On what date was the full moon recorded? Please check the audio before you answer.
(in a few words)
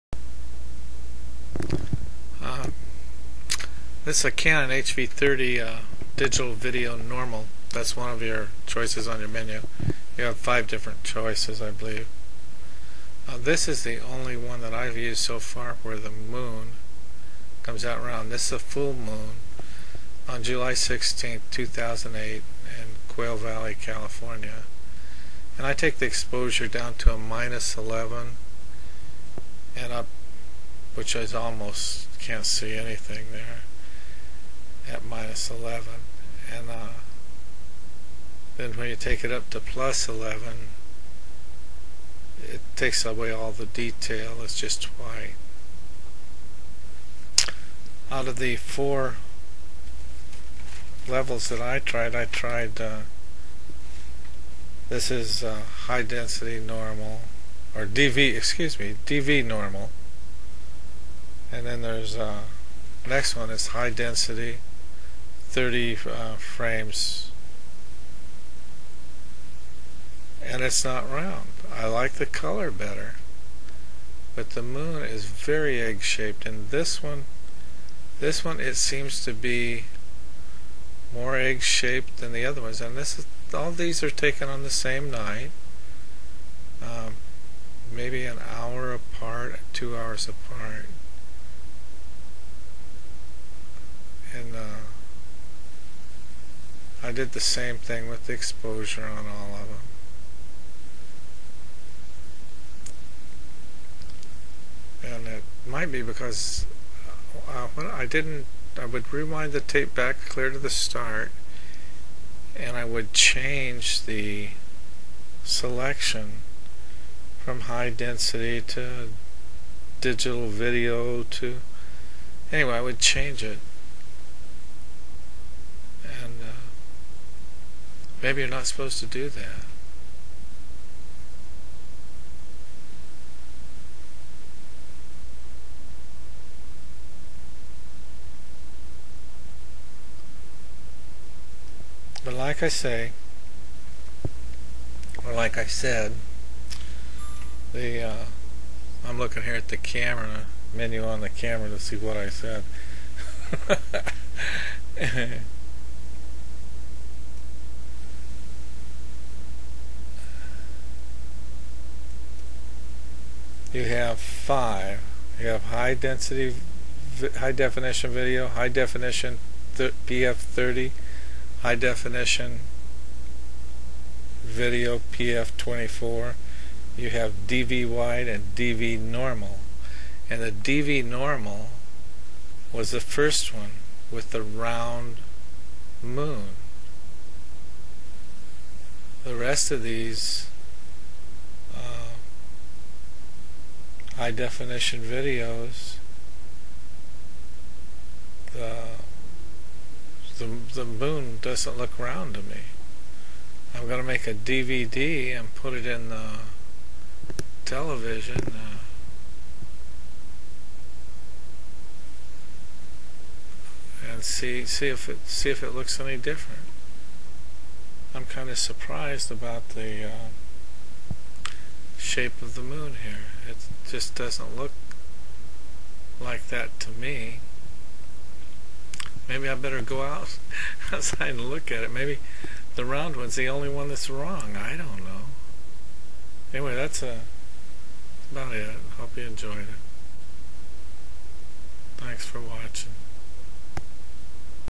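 July 16, 2008.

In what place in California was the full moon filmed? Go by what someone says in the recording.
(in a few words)
Quail Valley.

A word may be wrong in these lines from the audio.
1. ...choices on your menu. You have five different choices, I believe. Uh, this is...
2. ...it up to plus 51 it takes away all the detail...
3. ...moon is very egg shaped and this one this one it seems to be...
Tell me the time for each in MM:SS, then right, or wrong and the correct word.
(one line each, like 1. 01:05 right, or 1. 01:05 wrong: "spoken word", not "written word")
1. 00:08 right
2. 00:39 wrong: "11", not "51"
3. 01:14 right.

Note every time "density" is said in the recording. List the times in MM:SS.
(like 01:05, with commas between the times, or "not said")
00:56, 01:03, 01:57, 02:45.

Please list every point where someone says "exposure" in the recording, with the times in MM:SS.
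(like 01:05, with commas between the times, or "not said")
00:26, 01:38.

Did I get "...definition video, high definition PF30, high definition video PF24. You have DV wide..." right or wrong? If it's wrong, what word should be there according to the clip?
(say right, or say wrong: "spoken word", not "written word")
right.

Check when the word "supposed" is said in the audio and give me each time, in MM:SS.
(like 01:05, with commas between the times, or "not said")
02:08.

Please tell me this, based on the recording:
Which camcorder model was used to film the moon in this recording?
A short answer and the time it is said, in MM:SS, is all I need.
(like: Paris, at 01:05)
Canon HV30, at 00:04.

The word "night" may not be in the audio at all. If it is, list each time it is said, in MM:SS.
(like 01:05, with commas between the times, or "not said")
01:25.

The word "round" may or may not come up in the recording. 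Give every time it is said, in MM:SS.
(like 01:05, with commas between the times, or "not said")
00:18, 01:11, 03:04, 03:21, 03:52.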